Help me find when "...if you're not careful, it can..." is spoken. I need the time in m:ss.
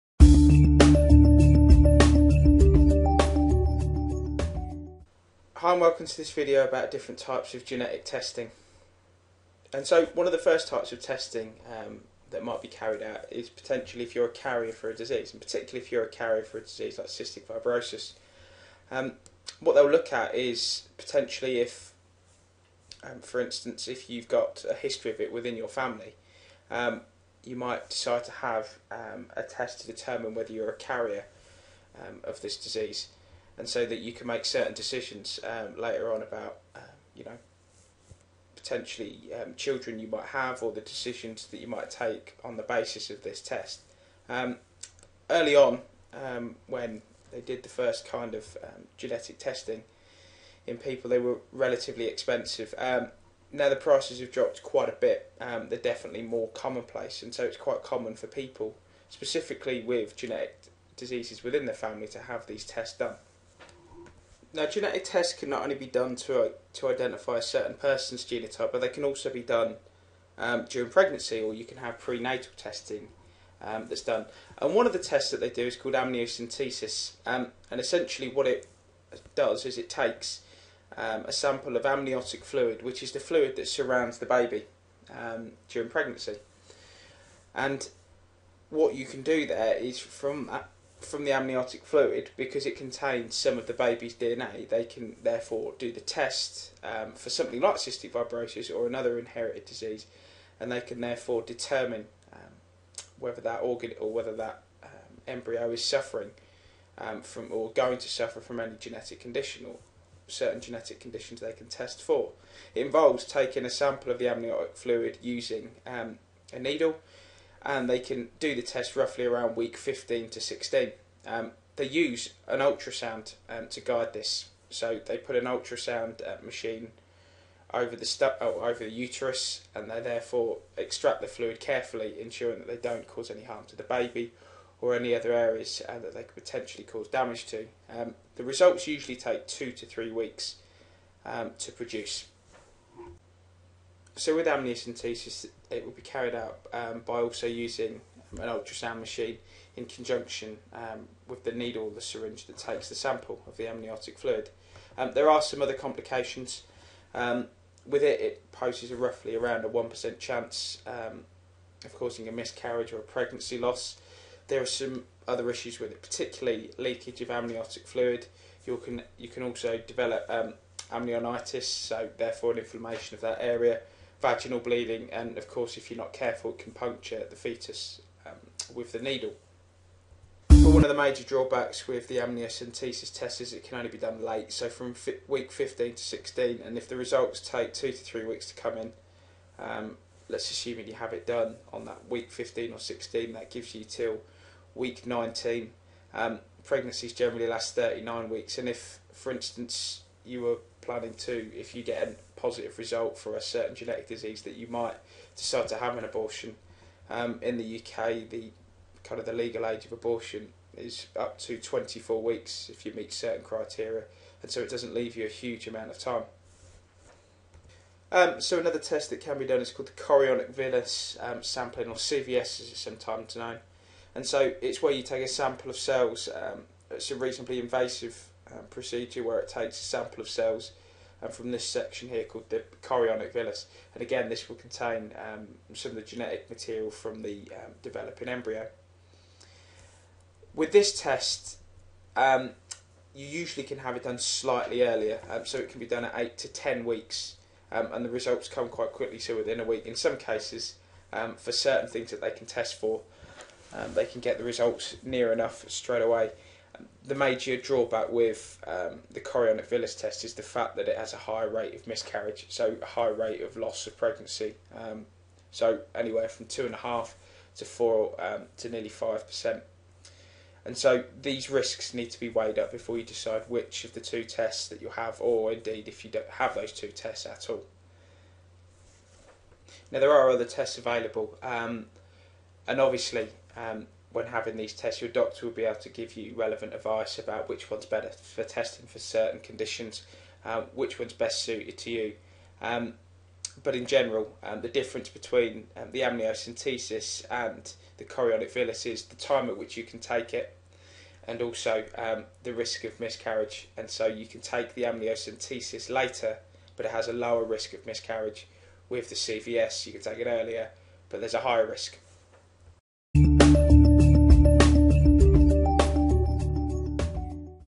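2:55.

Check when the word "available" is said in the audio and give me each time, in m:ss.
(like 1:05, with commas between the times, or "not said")
4:40.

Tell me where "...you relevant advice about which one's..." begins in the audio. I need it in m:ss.
4:46.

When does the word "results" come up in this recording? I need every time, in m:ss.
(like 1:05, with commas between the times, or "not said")
2:18, 3:06, 3:22, 4:08, 4:14.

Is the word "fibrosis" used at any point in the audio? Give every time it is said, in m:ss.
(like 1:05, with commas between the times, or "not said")
0:17, 1:38.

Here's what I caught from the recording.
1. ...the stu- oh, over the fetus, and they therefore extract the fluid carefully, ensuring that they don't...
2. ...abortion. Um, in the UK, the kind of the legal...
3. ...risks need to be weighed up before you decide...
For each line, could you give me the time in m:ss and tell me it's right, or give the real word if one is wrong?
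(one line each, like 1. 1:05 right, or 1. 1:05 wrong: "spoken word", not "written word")
1. 2:07 wrong: "uterus", not "fetus"
2. 3:26 right
3. 4:31 right.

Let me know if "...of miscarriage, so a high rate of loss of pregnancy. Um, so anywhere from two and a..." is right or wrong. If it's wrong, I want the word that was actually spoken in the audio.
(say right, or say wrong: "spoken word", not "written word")
right.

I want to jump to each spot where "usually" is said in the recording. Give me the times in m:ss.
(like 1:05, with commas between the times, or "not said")
2:18, 4:03.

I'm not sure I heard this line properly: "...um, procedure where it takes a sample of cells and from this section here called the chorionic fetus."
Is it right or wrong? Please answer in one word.
wrong.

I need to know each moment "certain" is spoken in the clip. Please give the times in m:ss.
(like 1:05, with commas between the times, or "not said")
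0:34, 1:07, 1:50, 3:23, 3:33, 4:11, 4:48.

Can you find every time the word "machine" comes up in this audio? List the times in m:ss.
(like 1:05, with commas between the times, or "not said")
2:06, 2:28.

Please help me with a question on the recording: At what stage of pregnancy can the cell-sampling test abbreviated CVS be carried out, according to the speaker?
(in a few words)
8 to 10 weeks.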